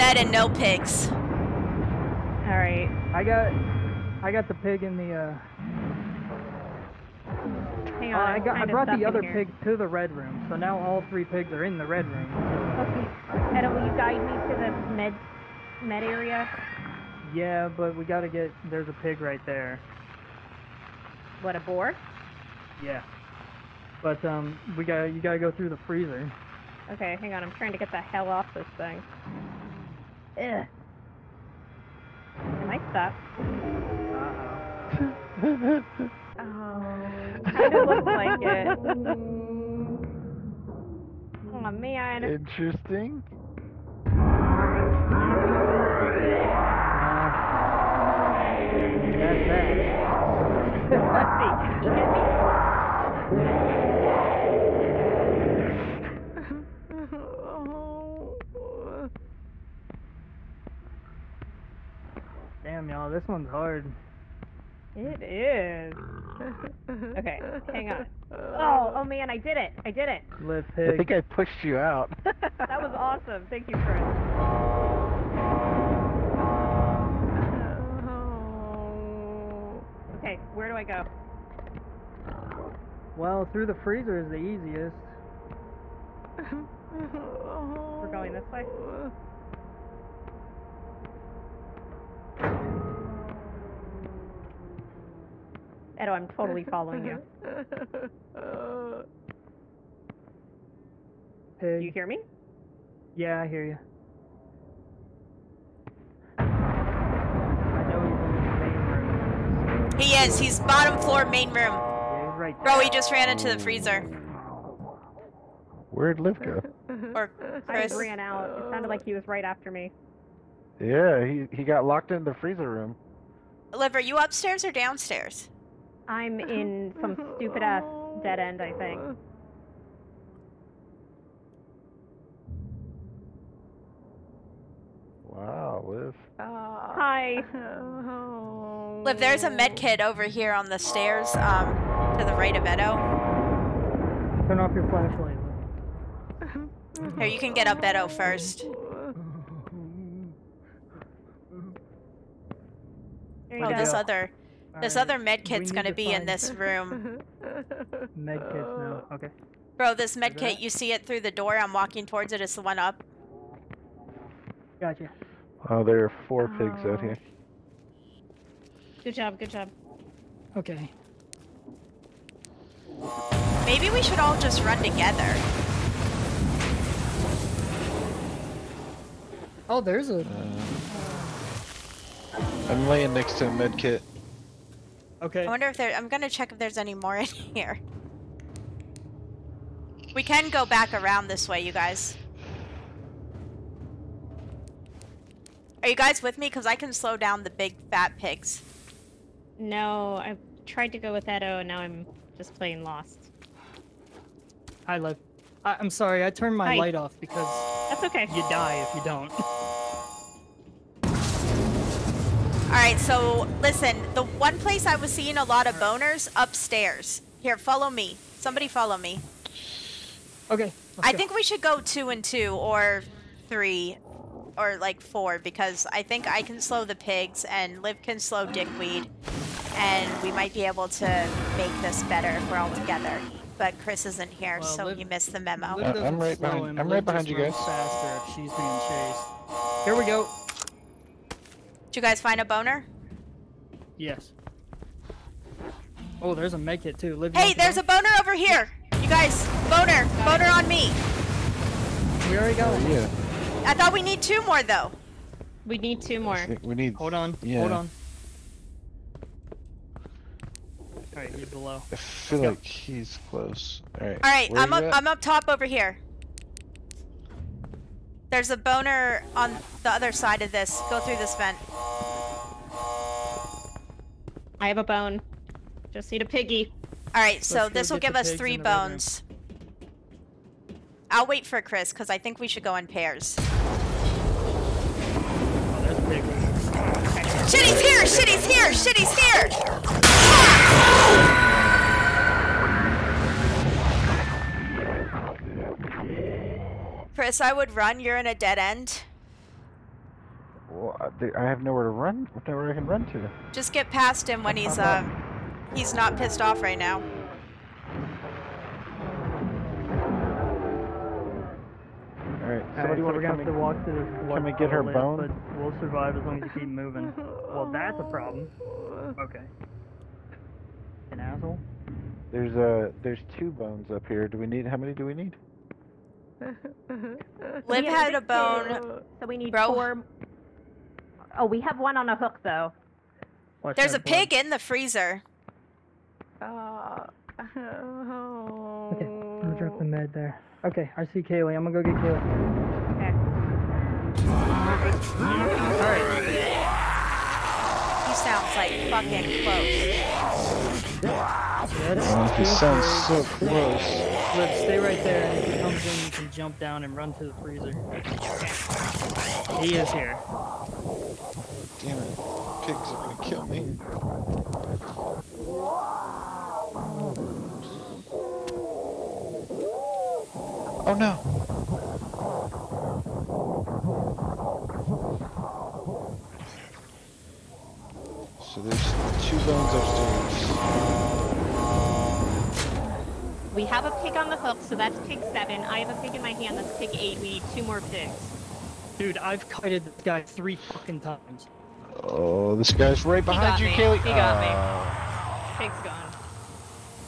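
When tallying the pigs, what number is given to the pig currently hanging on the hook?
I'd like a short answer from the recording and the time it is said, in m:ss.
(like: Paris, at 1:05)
7, at 6:25.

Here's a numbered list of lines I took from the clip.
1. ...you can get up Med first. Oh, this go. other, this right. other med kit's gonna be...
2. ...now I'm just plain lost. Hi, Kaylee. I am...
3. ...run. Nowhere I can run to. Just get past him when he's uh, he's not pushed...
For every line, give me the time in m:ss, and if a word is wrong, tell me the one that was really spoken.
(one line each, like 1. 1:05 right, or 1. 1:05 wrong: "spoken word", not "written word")
1. 2:27 wrong: "Etto", not "Med"
2. 3:21 wrong: "Liv", not "Kaylee"
3. 5:01 wrong: "pissed", not "pushed".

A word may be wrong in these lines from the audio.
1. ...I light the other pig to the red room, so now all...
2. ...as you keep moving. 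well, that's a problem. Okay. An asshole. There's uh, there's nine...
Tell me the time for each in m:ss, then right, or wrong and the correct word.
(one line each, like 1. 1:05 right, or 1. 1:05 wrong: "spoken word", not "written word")
1. 0:08 wrong: "brought", not "light"
2. 5:16 wrong: "two", not "nine".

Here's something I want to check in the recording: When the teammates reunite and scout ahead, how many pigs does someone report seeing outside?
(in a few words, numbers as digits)
4.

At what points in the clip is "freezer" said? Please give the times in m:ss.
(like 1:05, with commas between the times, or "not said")
0:25, 1:23, 1:53, 2:02, 5:34, 5:57.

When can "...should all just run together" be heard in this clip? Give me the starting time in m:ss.
2:54.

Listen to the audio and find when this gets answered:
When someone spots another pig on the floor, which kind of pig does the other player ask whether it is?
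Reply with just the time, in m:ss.
0:21.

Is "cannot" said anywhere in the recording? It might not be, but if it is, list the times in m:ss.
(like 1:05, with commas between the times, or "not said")
not said.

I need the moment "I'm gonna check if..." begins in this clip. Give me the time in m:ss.
3:05.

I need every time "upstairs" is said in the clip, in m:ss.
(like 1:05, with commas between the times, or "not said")
2:04, 3:36, 6:19.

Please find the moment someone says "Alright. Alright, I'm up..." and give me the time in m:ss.
4:23.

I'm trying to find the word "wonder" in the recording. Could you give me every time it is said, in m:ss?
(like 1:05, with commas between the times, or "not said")
3:05.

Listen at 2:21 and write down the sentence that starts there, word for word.
Um, to the right of Etto.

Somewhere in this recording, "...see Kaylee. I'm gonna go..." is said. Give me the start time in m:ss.
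5:41.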